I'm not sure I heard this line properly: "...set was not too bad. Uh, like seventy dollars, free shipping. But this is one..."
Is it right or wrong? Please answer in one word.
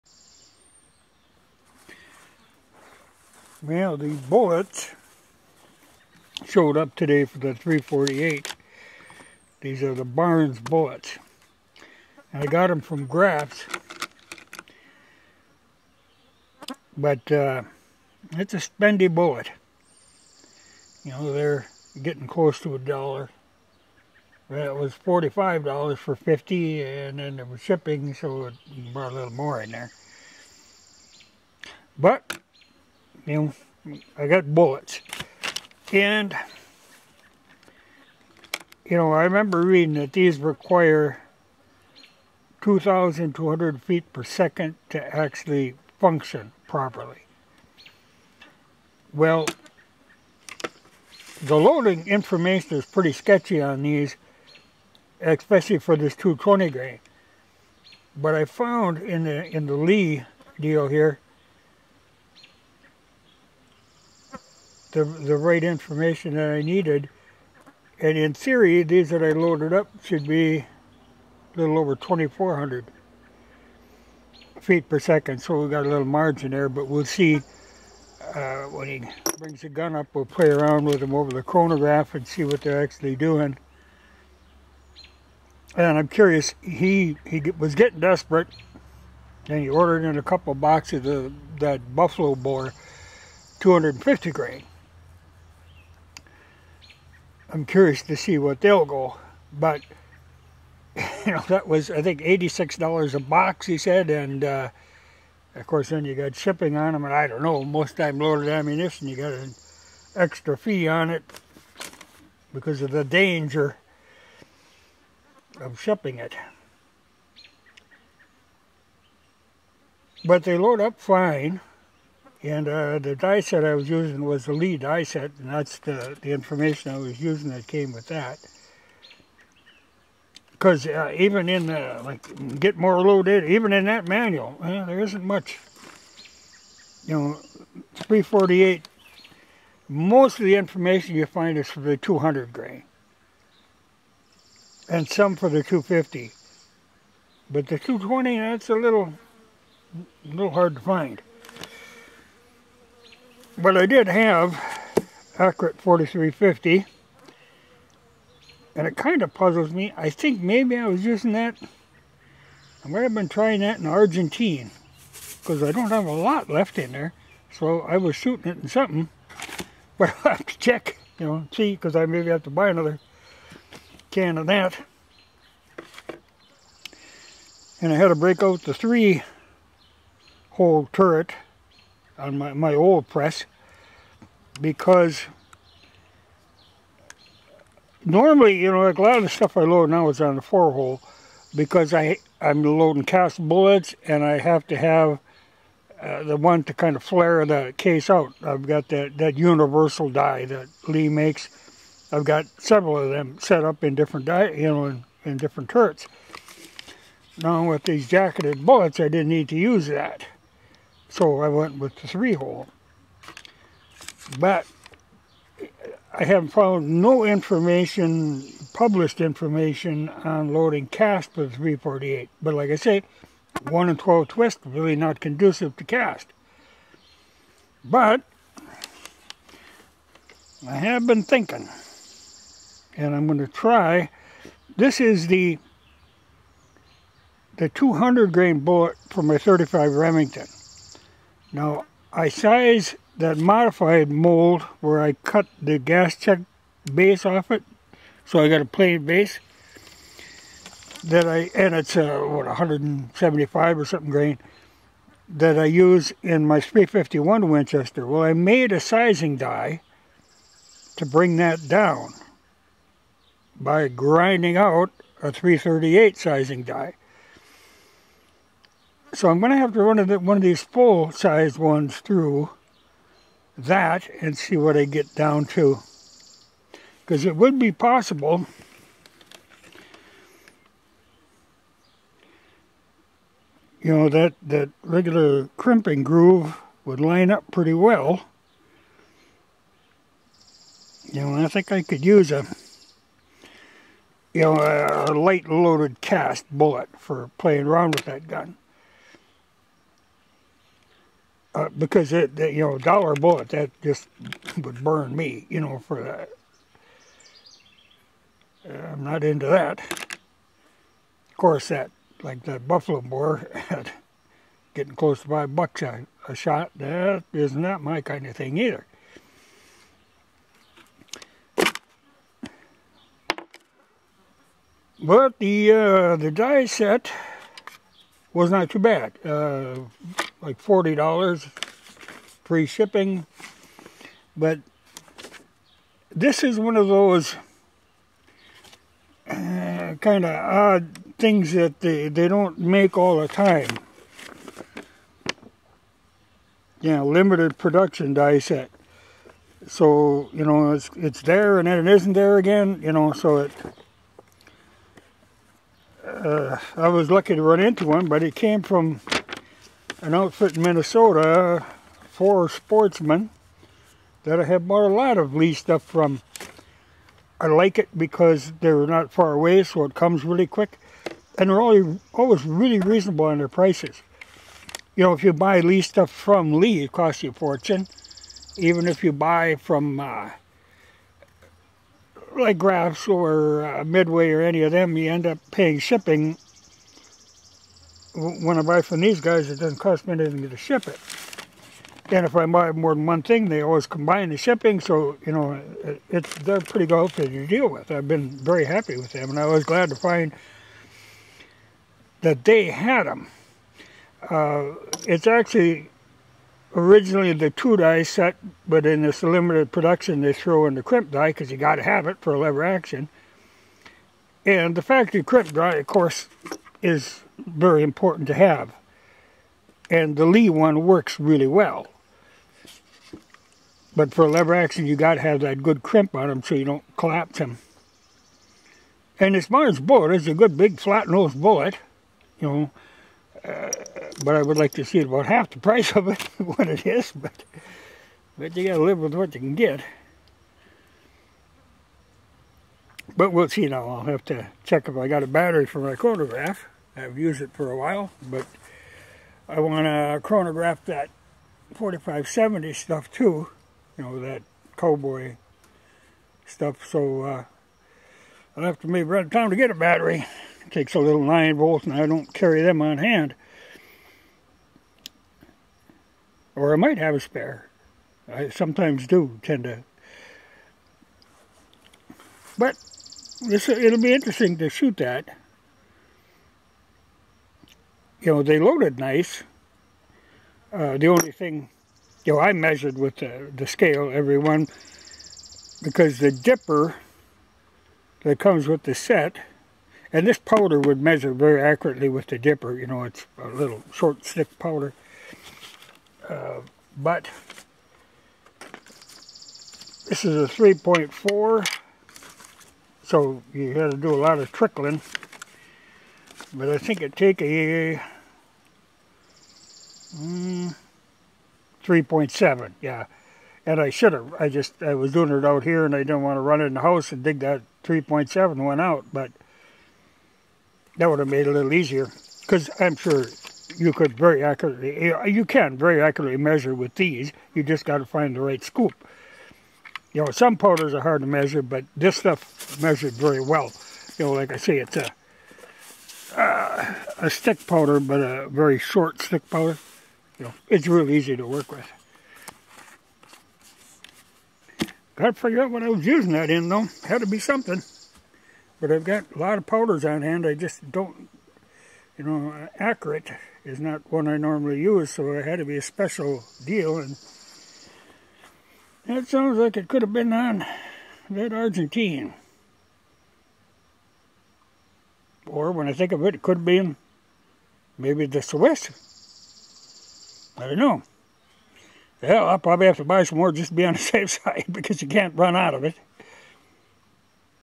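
wrong.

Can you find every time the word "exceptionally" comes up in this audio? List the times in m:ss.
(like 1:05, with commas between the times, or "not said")
not said.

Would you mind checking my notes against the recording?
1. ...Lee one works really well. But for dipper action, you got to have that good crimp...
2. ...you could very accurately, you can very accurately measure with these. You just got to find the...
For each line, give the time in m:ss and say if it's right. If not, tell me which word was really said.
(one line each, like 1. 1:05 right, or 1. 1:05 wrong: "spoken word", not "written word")
1. 7:00 wrong: "lever", not "dipper"
2. 8:43 right.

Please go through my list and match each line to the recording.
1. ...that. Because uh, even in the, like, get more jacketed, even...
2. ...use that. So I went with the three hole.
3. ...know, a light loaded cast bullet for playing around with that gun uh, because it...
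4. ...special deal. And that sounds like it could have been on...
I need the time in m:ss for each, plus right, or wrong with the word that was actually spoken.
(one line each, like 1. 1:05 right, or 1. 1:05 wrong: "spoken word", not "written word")
1. 2:08 wrong: "loaded", not "jacketed"
2. 3:29 right
3. 4:54 right
4. 9:15 right.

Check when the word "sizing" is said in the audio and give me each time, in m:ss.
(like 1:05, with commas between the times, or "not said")
4:18, 4:26.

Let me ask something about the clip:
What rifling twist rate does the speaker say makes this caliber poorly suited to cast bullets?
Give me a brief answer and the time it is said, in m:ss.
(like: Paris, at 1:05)
1 in 12, at 3:43.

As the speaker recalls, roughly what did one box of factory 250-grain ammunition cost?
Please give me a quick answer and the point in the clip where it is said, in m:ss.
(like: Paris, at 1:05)
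$86, at 1:42.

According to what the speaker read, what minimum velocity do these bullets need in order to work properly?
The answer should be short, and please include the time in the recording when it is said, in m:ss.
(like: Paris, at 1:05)
2,200 feet per second, at 0:42.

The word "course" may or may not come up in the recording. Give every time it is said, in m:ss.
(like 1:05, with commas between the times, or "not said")
1:45, 5:11, 6:55.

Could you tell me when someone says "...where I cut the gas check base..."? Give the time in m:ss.
4:04.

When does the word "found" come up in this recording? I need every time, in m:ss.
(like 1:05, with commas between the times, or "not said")
0:58, 3:36.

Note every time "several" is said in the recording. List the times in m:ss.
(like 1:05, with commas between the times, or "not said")
3:22.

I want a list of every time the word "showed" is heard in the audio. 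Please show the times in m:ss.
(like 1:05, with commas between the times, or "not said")
0:06.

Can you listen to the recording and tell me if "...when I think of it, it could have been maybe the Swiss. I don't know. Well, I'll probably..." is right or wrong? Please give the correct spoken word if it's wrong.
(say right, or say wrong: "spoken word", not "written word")
right.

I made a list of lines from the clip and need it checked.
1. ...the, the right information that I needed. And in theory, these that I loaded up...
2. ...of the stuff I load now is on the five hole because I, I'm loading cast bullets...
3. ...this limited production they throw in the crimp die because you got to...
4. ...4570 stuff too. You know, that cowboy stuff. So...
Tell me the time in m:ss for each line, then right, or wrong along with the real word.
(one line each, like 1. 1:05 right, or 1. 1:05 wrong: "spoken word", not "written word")
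1. 1:04 right
2. 3:09 wrong: "four", not "five"
3. 6:49 right
4. 7:31 right.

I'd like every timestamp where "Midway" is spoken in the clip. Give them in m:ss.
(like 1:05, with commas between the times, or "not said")
6:23.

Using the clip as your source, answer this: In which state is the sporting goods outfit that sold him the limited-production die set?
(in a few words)
Minnesota.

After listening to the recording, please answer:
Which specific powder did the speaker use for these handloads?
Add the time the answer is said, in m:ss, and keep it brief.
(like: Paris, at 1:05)
Accurate 4350, at 2:35.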